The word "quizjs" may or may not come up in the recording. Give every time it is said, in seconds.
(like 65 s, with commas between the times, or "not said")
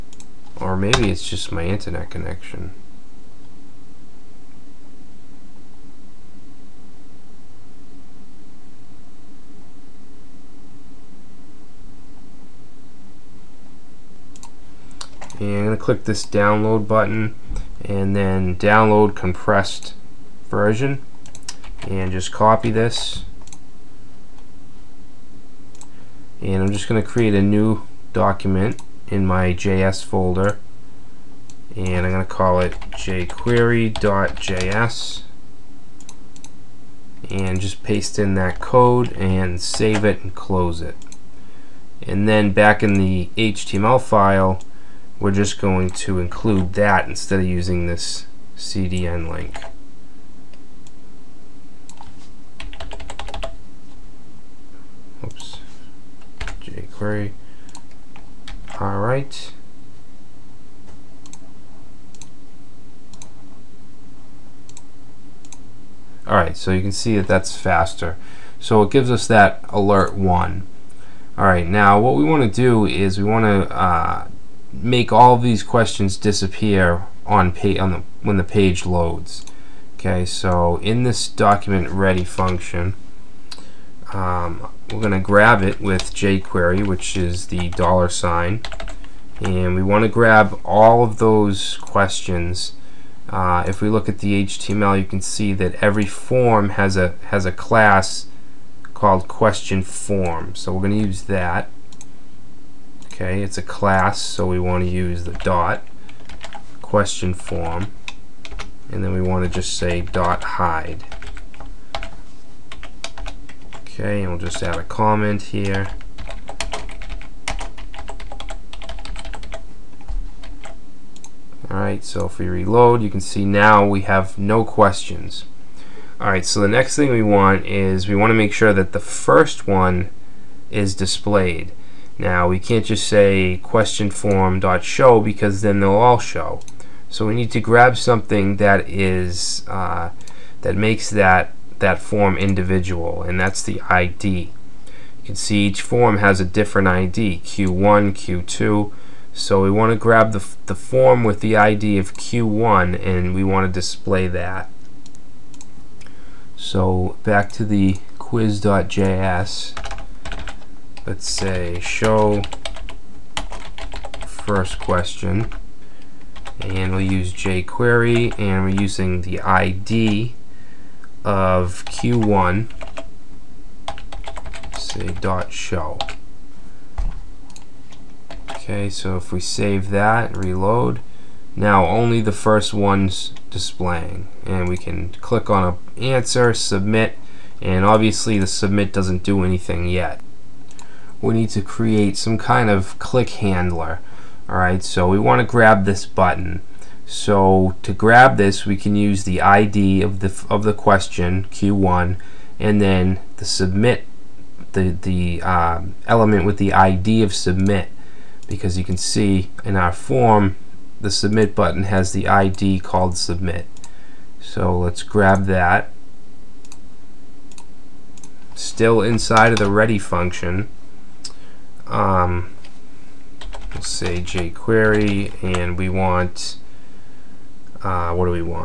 158 s.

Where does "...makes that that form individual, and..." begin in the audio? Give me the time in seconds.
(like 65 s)
140 s.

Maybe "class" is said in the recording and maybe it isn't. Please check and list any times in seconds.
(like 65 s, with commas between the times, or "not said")
97 s, 103 s.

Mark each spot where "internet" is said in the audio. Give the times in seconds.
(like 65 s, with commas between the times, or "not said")
1 s.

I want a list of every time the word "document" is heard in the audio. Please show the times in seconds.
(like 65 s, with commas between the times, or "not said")
28 s, 81 s.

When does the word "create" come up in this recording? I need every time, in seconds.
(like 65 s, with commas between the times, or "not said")
27 s, 191 s.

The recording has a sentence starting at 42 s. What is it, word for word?
And then back in the HTML file, we're just going to include that instead of using this CDN link.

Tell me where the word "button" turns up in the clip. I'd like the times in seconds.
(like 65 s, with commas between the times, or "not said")
16 s, 196 s, 211 s.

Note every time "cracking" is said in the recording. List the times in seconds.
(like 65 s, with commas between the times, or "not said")
not said.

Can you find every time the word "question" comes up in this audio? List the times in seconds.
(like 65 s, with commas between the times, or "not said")
75 s, 91 s, 99 s, 106 s, 124 s, 133 s, 164 s, 200 s.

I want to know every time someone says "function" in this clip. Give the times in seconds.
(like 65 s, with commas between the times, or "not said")
82 s, 219 s.